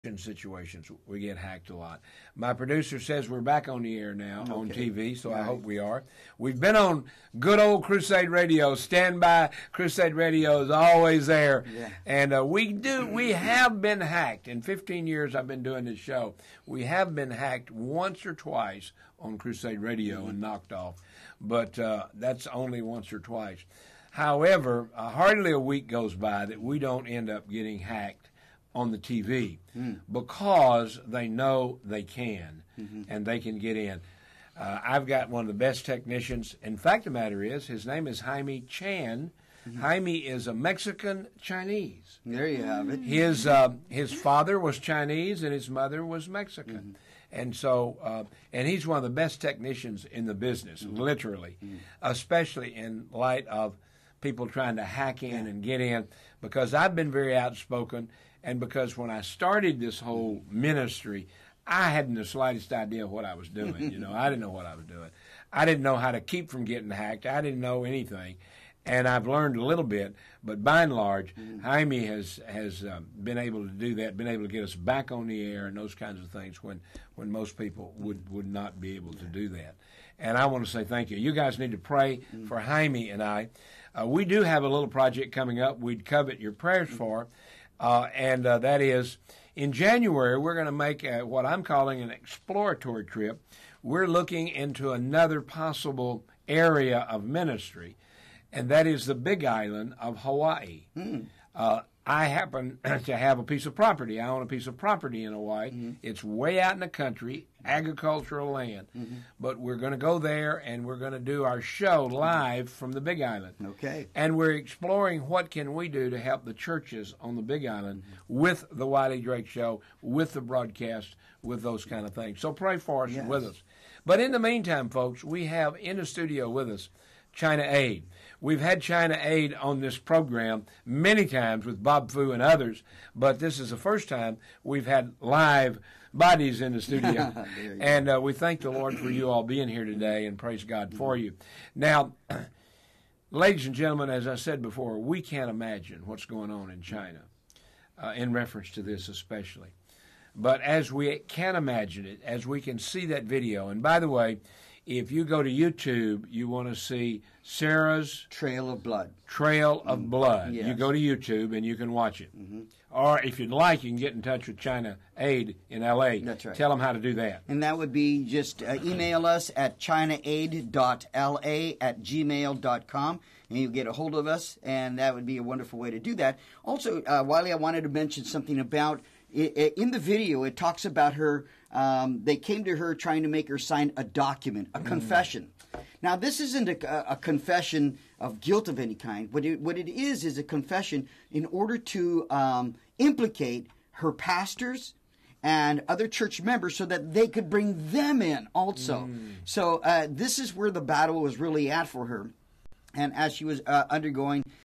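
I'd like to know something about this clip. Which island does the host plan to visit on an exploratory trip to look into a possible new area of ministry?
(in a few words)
Big Island of Hawaii.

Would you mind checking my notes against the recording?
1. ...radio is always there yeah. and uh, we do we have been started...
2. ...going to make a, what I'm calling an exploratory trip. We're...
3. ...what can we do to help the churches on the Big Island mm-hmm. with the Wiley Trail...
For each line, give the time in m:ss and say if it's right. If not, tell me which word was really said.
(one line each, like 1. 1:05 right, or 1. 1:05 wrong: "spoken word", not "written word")
1. 0:10 wrong: "hacked", not "started"
2. 1:30 right
3. 1:55 wrong: "Drake", not "Trail".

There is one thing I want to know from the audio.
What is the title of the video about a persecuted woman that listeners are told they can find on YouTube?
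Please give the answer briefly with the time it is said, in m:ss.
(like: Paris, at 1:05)
Sarah's Trail of Blood, at 2:37.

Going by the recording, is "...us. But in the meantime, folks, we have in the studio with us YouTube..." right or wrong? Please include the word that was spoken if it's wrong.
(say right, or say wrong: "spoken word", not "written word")
wrong: "China", not "YouTube".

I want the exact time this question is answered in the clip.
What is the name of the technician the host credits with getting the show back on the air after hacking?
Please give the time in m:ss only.
0:38.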